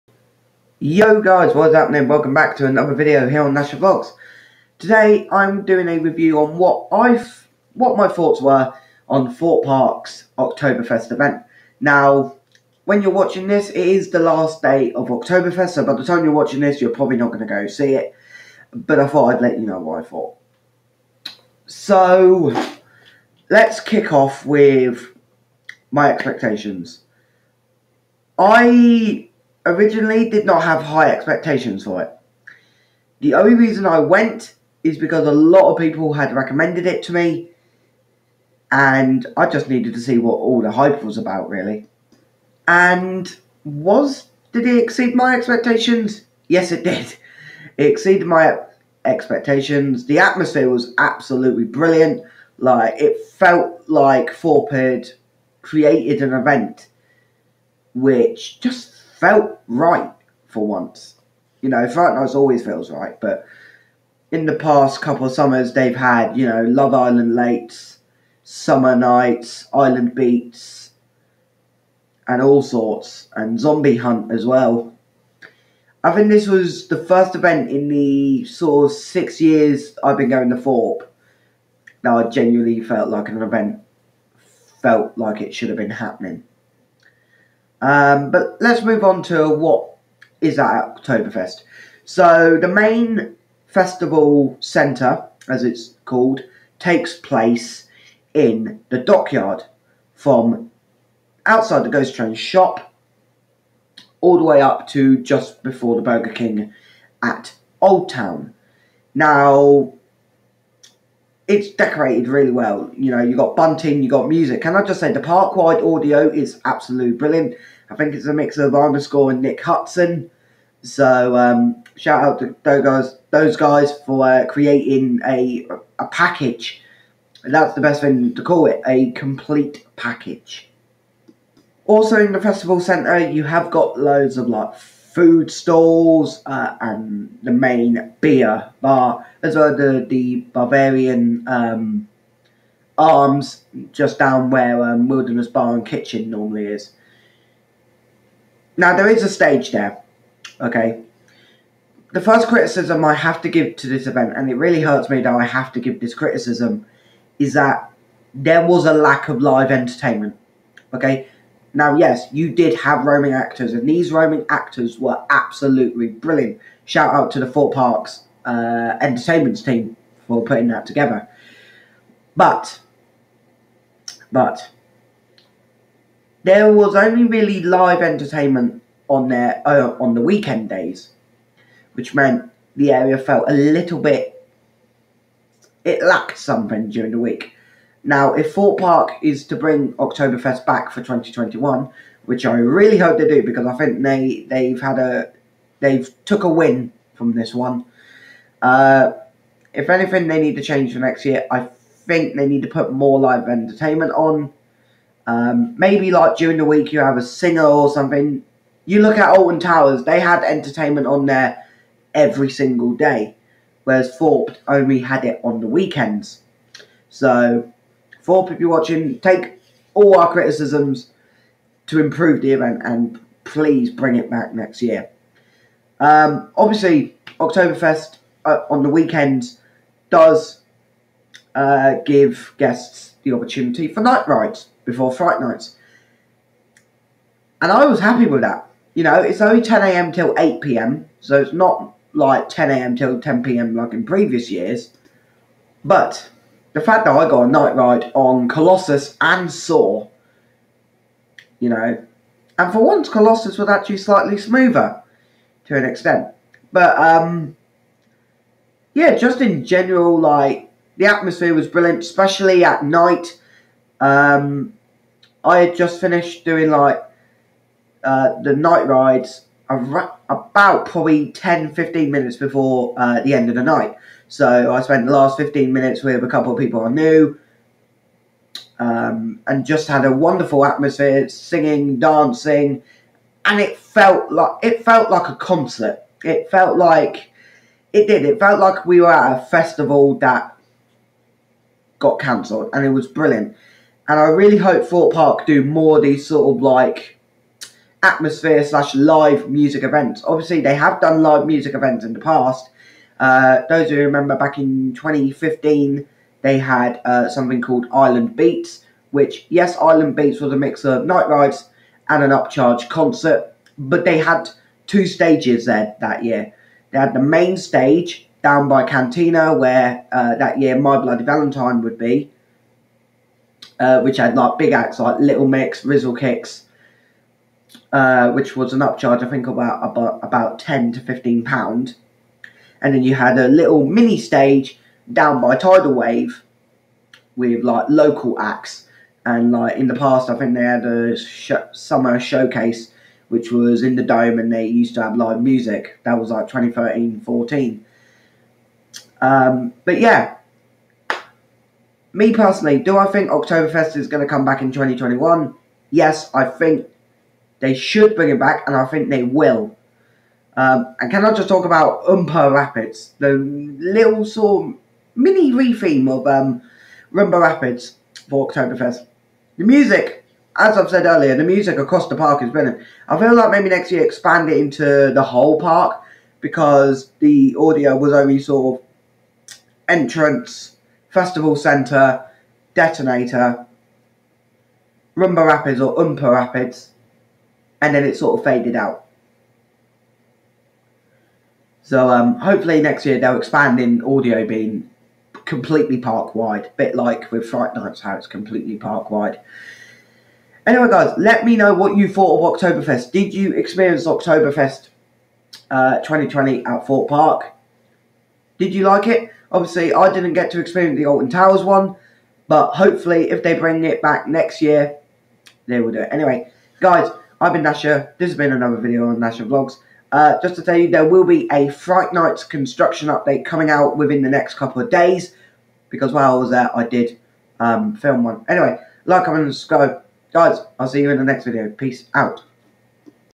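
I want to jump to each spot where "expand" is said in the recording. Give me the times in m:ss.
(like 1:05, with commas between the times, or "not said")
6:14, 6:33.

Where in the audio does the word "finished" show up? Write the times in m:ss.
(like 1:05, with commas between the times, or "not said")
4:25.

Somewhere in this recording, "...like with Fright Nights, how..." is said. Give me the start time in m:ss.
6:36.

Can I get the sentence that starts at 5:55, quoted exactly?
Yes, I think they should bring him back, and I think they will.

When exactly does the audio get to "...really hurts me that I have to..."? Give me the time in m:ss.
2:34.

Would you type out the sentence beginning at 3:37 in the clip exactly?
So for people watching, take all our criticisms to improve the event and please bring it back next year.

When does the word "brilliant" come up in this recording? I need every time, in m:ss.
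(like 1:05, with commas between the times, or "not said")
0:51, 1:57, 2:46, 4:21, 4:53, 6:12.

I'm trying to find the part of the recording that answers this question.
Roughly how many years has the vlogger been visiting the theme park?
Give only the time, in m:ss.
1:18.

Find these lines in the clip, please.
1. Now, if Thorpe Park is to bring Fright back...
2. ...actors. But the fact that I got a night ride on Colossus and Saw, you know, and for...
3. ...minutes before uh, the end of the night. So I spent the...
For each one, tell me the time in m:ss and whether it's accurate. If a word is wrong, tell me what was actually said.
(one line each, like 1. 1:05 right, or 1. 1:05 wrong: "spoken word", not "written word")
1. 3:08 wrong: "Oktoberfest", not "Fright"
2. 4:04 wrong: "years", not "actors"
3. 4:32 right.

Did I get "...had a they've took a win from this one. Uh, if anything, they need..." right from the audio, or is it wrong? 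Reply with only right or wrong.
right.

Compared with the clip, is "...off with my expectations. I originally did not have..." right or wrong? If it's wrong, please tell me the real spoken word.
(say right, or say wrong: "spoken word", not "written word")
right.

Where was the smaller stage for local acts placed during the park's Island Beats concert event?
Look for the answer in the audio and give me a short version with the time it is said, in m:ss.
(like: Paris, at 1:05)
by Tidal Wave, at 5:35.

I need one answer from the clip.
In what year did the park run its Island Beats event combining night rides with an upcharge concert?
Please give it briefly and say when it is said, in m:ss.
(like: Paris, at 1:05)
2015, at 5:04.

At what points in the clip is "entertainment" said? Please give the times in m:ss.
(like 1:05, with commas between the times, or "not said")
2:39, 2:58, 3:23, 3:30.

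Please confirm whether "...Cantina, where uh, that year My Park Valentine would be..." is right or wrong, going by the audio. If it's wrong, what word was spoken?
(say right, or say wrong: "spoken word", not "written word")
wrong: "Bloody", not "Park".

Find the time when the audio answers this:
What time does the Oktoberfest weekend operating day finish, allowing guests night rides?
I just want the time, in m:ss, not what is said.
4:00.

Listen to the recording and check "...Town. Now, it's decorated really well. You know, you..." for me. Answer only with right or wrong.
right.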